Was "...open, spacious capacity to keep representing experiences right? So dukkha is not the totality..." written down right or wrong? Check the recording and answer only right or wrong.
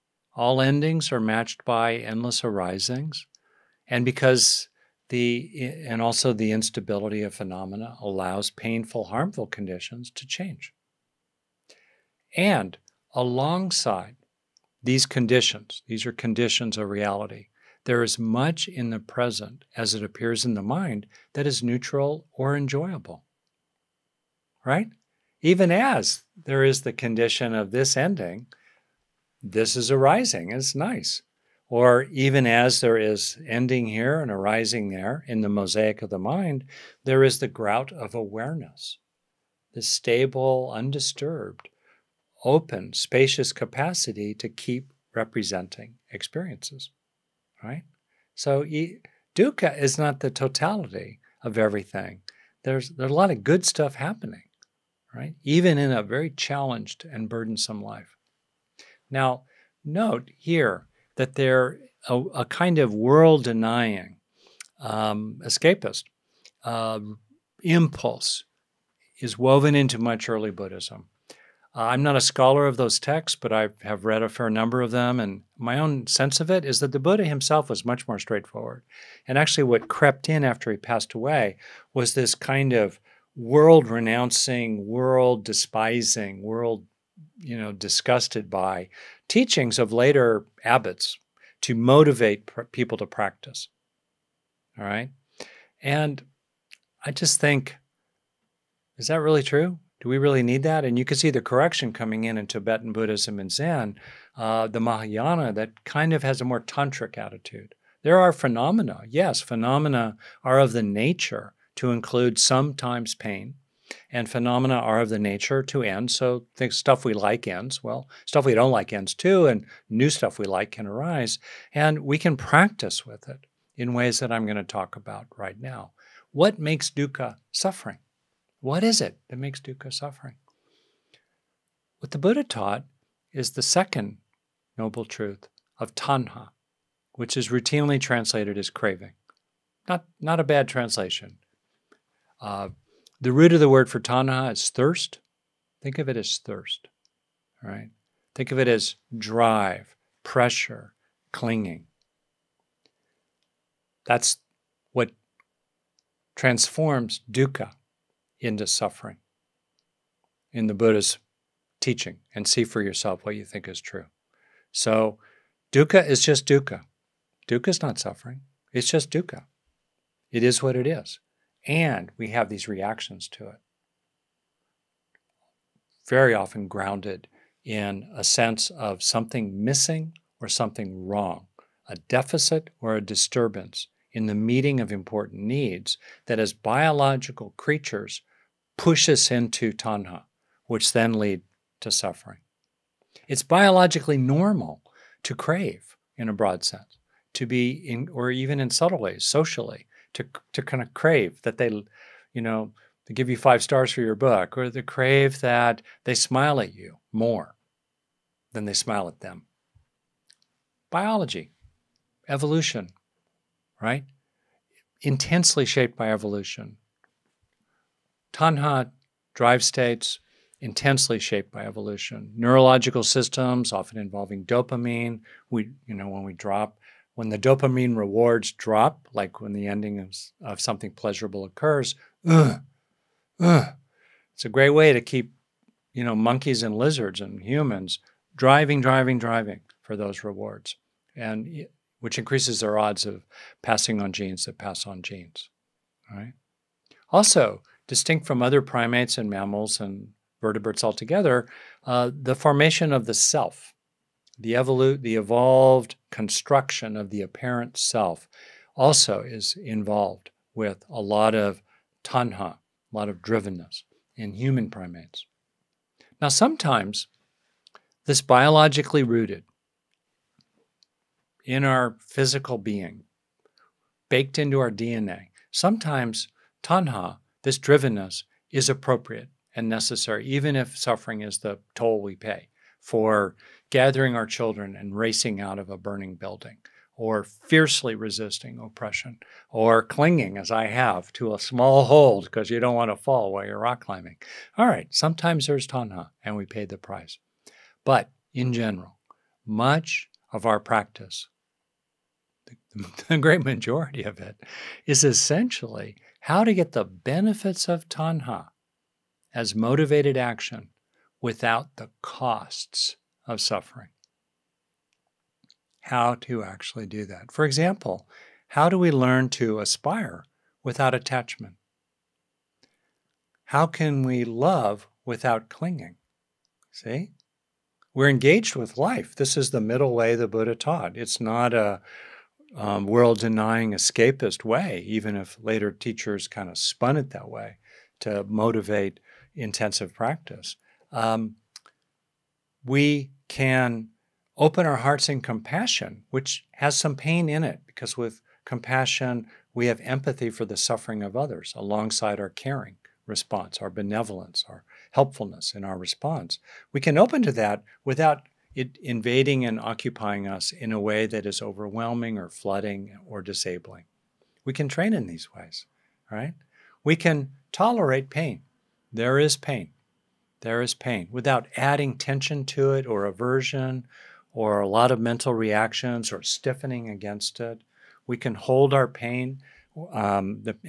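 right.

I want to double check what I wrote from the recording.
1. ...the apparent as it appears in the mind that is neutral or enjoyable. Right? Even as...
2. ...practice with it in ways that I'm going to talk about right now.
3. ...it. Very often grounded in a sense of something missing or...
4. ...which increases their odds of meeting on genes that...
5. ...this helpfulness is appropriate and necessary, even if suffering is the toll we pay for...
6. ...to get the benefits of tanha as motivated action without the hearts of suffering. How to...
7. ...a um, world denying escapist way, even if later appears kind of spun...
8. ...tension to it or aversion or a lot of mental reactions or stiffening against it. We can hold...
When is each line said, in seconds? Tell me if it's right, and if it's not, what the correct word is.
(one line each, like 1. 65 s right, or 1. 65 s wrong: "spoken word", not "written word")
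1. 18 s wrong: "present", not "apparent"
2. 122 s right
3. 173 s right
4. 241 s wrong: "passing", not "meeting"
5. 277 s wrong: "drivenness", not "helpfulness"
6. 306 s wrong: "costs", not "hearts"
7. 331 s wrong: "teachers", not "appears"
8. 371 s right.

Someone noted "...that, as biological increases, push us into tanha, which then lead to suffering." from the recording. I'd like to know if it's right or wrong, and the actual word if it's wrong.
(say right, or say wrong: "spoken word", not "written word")
wrong: "creatures", not "increases".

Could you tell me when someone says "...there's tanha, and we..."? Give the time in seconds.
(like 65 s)
295 s.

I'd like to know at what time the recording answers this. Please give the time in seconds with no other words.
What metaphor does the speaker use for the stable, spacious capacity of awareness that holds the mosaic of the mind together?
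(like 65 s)
37 s.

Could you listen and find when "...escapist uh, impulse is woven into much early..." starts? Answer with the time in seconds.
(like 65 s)
65 s.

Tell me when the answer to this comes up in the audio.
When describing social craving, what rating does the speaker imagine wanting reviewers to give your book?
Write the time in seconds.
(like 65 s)
203 s.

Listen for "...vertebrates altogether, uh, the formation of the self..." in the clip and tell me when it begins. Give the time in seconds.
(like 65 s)
250 s.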